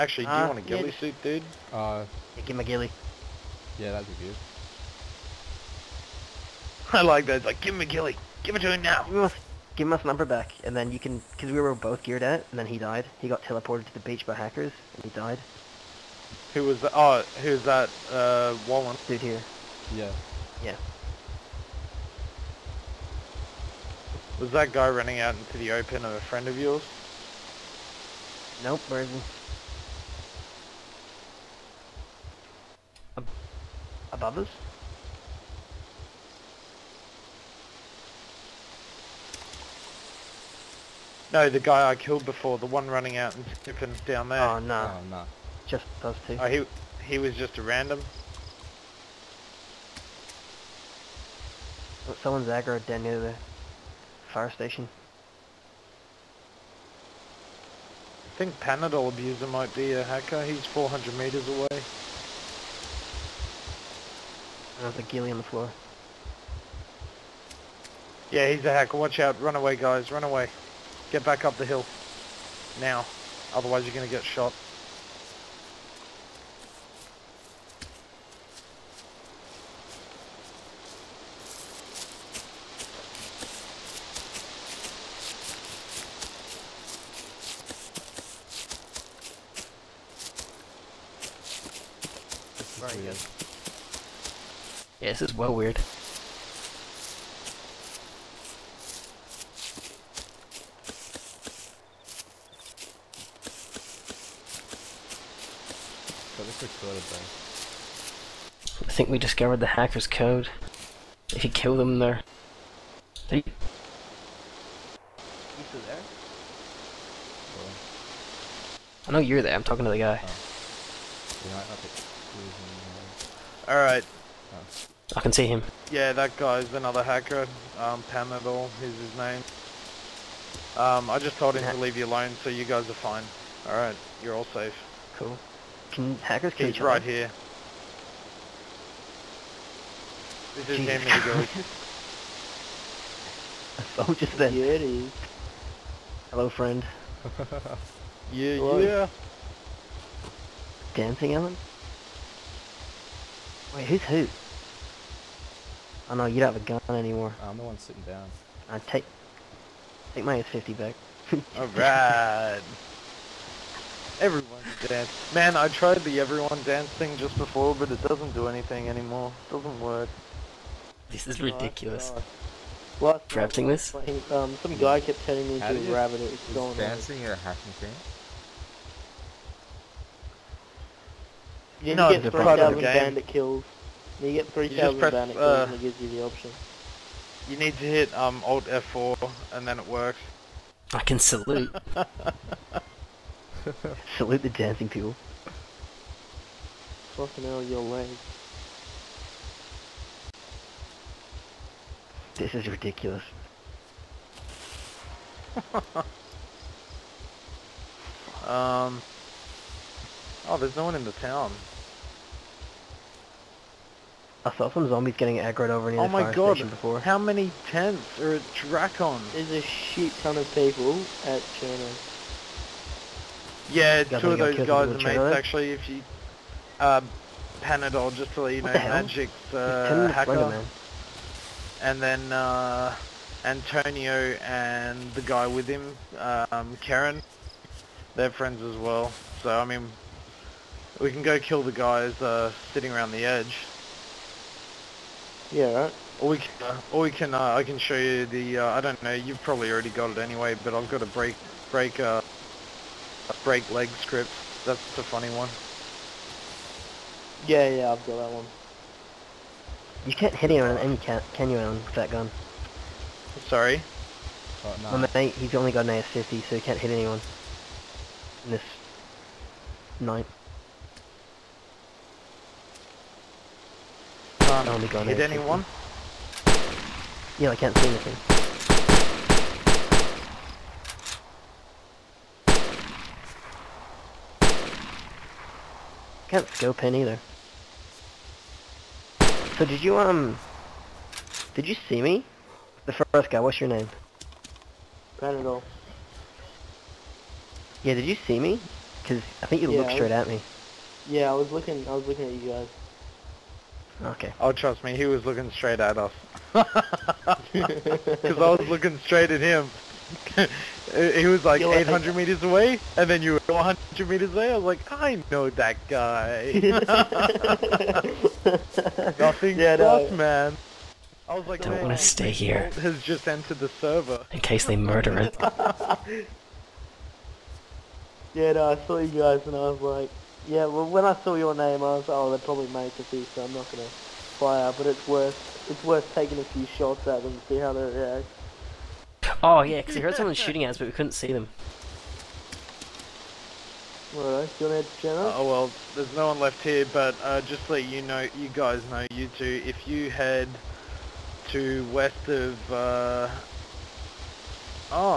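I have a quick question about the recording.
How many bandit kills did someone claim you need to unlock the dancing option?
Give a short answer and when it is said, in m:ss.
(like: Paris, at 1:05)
3,000, at 3:02.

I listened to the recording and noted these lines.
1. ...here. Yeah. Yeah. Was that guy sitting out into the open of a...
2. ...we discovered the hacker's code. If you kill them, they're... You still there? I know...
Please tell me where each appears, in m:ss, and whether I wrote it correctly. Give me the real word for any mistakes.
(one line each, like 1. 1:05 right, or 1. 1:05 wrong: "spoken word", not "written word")
1. 0:19 wrong: "running", not "sitting"
2. 1:49 right.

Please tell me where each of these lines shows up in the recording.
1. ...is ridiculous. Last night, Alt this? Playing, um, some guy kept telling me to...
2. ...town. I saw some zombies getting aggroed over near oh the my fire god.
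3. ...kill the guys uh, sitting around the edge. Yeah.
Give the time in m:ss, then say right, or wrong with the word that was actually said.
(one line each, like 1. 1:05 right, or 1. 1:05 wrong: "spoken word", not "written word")
1. 2:51 wrong: "Drafting", not "Alt"
2. 3:31 right
3. 4:01 right.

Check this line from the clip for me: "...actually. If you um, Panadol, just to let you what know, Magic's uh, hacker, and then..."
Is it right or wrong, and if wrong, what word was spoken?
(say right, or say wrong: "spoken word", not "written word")
right.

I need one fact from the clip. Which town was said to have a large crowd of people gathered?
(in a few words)
Cherno.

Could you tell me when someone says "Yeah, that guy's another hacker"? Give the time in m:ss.
2:05.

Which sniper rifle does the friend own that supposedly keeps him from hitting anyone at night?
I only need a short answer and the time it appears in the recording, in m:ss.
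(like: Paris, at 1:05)
AS-50, at 4:25.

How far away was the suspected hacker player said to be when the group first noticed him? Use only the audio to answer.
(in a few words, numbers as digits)
400 meters.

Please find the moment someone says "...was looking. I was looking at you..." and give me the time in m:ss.
5:01.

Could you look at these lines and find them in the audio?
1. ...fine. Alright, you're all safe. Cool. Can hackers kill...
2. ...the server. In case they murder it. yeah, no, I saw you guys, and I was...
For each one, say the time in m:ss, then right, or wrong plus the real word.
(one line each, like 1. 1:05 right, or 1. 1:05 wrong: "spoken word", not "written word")
1. 2:12 right
2. 5:23 right.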